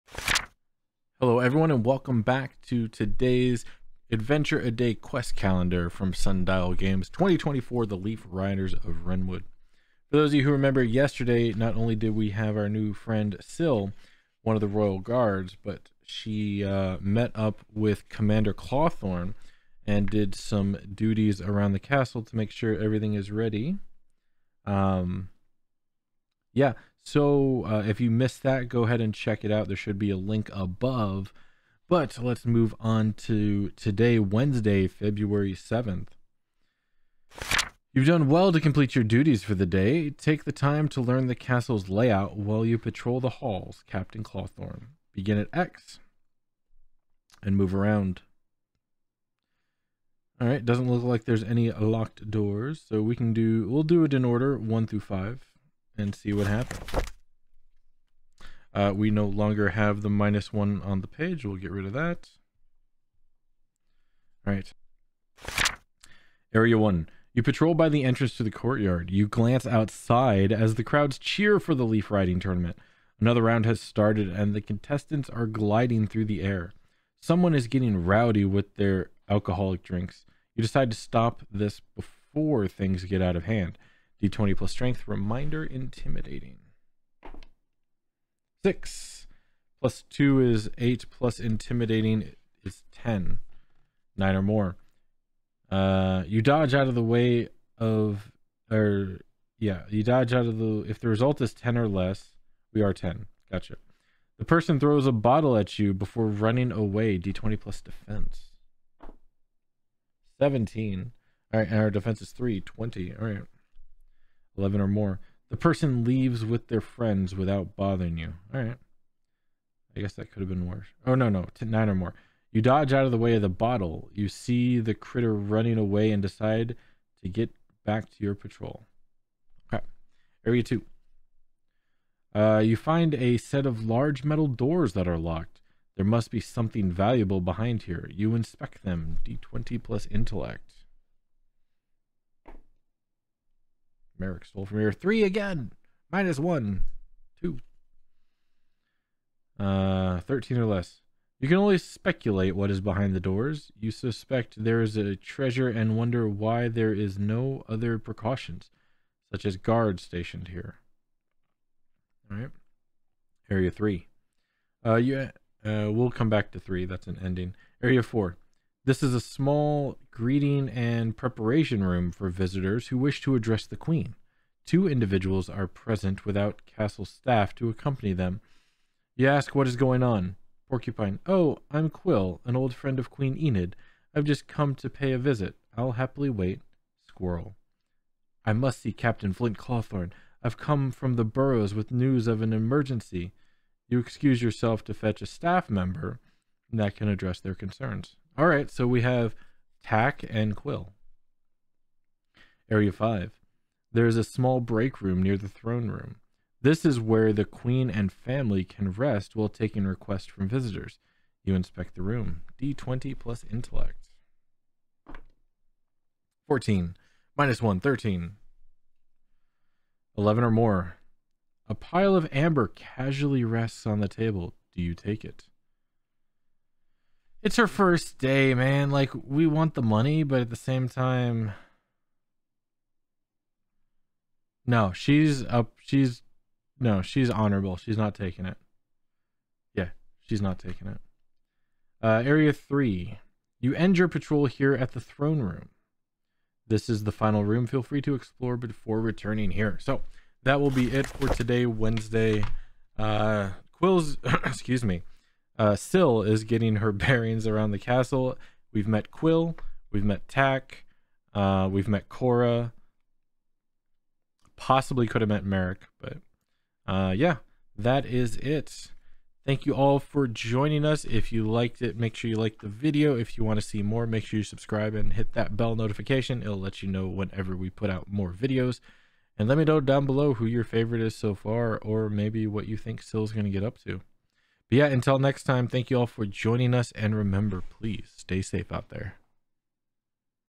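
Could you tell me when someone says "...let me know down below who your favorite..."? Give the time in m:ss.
4:39.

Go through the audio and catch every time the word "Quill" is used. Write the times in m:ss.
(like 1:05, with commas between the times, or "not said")
3:01, 3:20, 4:13, 4:19.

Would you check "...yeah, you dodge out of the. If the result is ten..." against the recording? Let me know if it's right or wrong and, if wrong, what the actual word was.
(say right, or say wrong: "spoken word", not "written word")
right.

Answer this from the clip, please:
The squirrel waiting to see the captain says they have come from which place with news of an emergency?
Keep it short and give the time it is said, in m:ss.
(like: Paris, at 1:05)
the burrows, at 3:11.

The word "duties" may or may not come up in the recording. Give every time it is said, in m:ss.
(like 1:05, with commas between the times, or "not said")
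0:20, 0:39.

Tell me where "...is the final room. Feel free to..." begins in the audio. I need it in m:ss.
4:06.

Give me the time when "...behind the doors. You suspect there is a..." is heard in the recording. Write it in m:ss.
2:32.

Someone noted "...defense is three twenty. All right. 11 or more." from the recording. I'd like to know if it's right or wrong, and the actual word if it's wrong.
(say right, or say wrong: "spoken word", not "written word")
right.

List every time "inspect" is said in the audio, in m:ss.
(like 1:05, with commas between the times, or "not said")
2:18, 3:31.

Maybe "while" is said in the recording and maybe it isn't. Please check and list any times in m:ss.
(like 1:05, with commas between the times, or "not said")
0:42, 3:29.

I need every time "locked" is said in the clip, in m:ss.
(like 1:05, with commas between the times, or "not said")
0:51, 2:15.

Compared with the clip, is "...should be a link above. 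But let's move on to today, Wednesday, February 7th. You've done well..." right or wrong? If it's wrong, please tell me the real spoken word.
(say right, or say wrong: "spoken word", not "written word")
right.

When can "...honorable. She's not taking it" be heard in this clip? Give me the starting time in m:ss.
3:57.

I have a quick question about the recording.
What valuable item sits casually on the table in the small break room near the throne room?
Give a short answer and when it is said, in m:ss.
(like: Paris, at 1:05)
amber, at 3:42.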